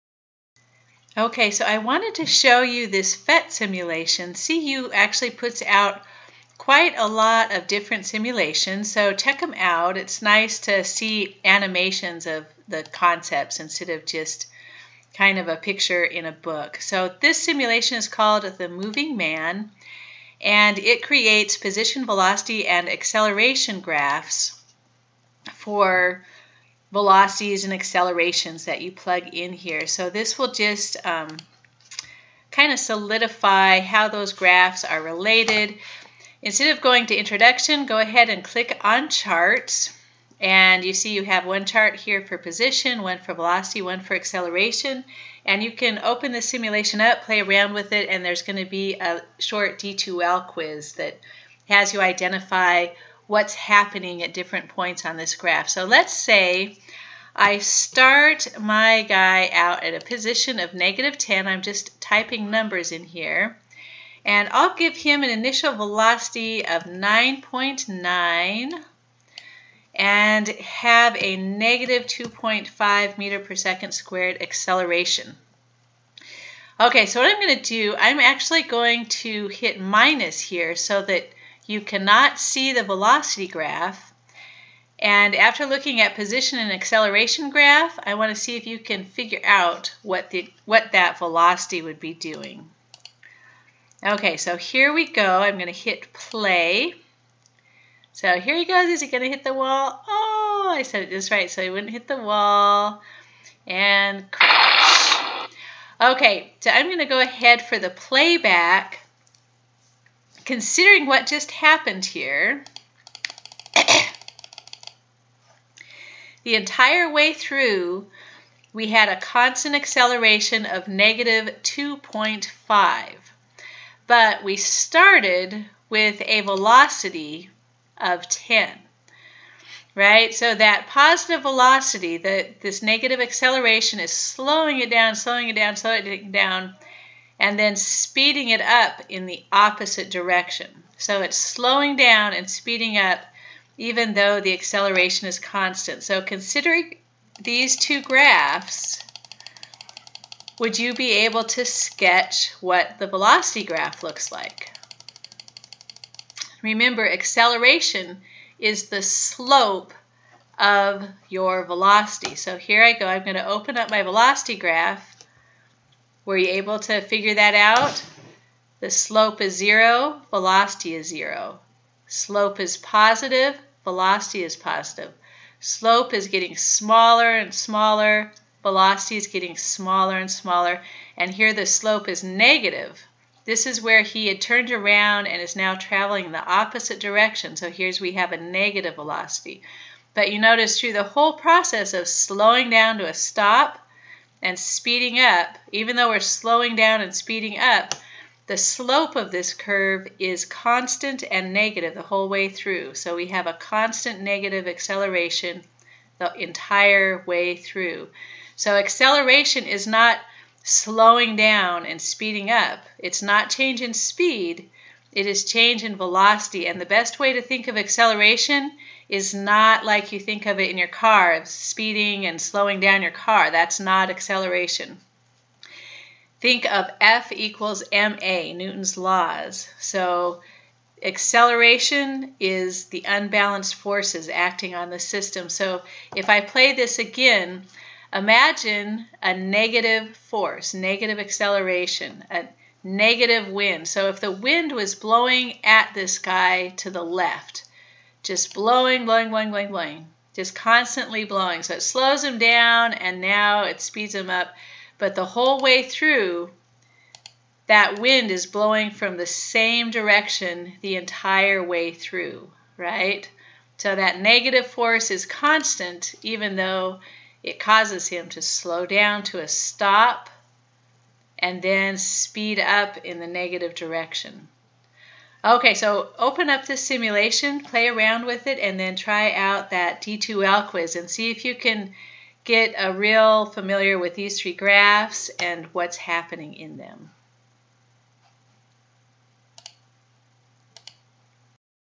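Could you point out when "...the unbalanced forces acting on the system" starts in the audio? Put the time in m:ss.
3:52.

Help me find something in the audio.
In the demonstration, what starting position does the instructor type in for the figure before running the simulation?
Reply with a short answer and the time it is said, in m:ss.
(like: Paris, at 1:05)
-10, at 1:00.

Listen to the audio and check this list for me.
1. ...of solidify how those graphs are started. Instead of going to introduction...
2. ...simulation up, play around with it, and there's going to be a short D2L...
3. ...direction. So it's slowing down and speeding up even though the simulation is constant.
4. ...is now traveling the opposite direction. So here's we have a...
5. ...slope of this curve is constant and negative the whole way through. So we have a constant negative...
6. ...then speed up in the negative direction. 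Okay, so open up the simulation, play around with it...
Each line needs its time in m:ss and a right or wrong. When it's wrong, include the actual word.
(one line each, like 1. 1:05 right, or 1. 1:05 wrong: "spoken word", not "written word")
1. 0:32 wrong: "related", not "started"
2. 0:46 right
3. 2:20 wrong: "acceleration", not "simulation"
4. 3:05 right
5. 3:18 right
6. 4:31 right.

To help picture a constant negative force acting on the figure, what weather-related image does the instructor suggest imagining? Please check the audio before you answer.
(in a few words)
a negative wind.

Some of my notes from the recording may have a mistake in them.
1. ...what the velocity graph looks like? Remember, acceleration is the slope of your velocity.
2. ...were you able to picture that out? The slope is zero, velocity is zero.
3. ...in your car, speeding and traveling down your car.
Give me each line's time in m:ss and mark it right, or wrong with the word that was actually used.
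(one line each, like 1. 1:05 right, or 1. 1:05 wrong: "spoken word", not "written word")
1. 2:32 right
2. 2:46 wrong: "figure", not "picture"
3. 3:40 wrong: "slowing", not "traveling".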